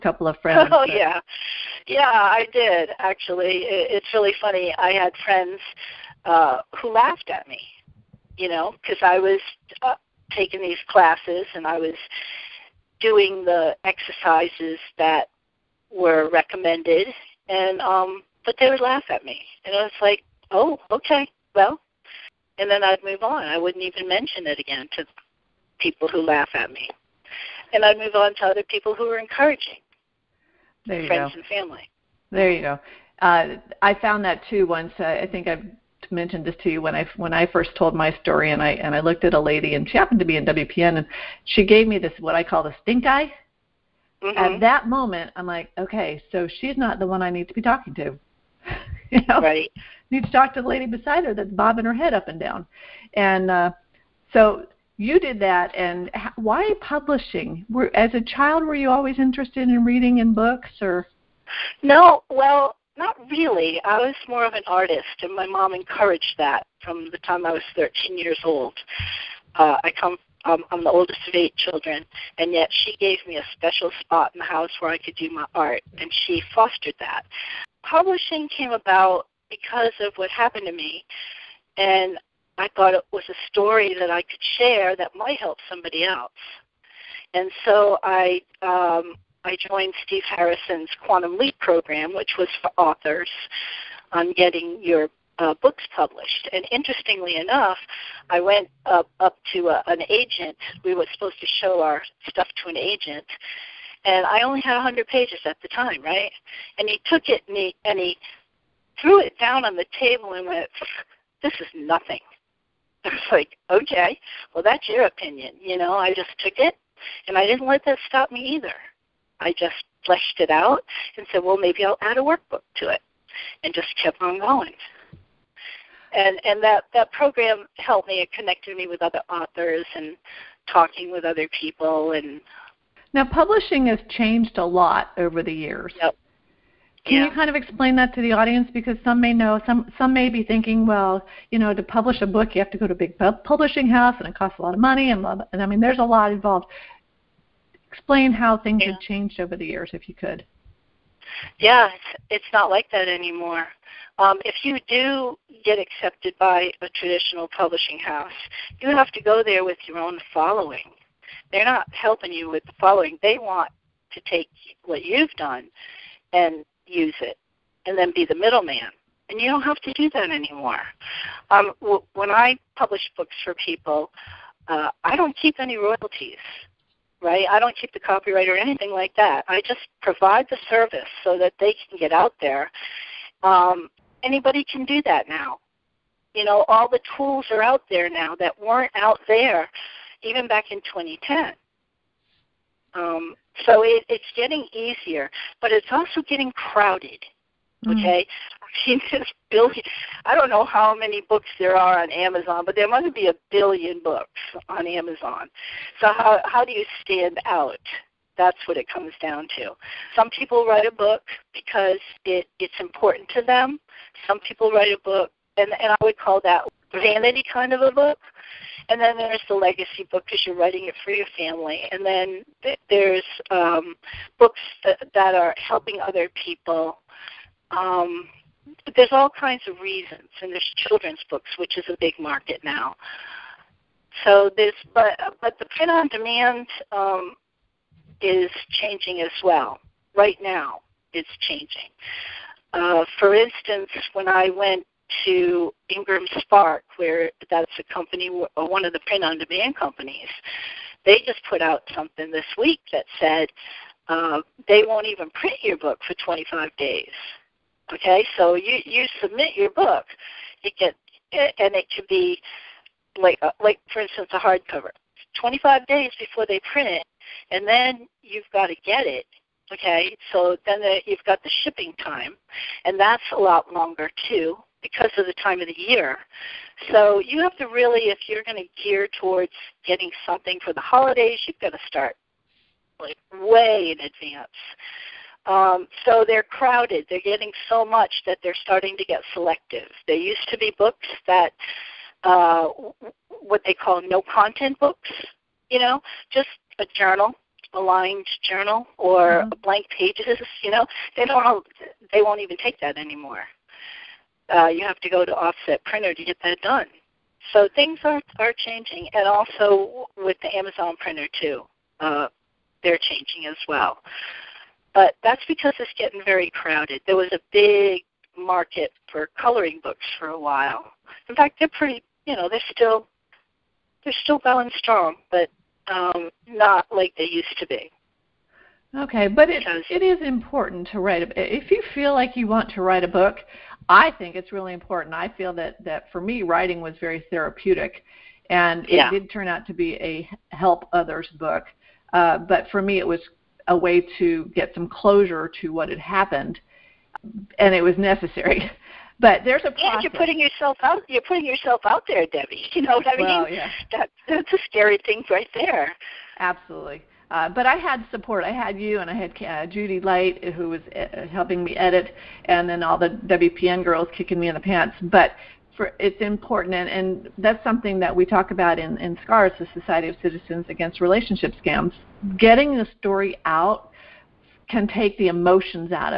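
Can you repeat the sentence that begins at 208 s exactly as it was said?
That's what it comes down to.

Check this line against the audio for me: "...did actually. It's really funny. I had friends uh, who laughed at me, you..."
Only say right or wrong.
right.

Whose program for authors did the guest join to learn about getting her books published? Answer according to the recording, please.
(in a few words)
Steve Harrison.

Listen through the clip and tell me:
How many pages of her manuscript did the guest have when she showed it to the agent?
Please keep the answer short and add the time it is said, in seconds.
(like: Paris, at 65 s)
100, at 104 s.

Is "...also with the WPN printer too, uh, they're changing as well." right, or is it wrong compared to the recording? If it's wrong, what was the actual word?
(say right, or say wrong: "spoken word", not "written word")
wrong: "Amazon", not "WPN".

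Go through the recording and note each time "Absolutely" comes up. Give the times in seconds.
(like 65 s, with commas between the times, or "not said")
356 s.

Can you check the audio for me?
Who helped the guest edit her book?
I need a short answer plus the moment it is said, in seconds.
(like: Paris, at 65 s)
Judy Light, at 359 s.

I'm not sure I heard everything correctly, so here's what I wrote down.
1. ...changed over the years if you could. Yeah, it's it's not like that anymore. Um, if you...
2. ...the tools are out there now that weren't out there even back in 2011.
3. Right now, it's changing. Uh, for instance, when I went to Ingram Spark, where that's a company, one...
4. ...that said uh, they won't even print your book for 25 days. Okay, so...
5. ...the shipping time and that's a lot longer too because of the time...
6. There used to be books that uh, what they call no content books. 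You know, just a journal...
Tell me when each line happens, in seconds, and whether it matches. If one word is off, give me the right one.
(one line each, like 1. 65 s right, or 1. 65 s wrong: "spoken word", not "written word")
1. 149 s right
2. 186 s wrong: "2010", not "2011"
3. 240 s right
4. 252 s right
5. 271 s right
6. 290 s right.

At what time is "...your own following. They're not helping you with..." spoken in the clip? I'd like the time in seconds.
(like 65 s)
159 s.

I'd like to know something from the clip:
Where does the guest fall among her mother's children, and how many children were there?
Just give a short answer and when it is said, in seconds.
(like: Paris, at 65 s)
Oldest of 8, at 70 s.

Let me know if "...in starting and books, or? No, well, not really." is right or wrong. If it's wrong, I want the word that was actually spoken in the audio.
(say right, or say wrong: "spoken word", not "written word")
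wrong: "reading", not "starting".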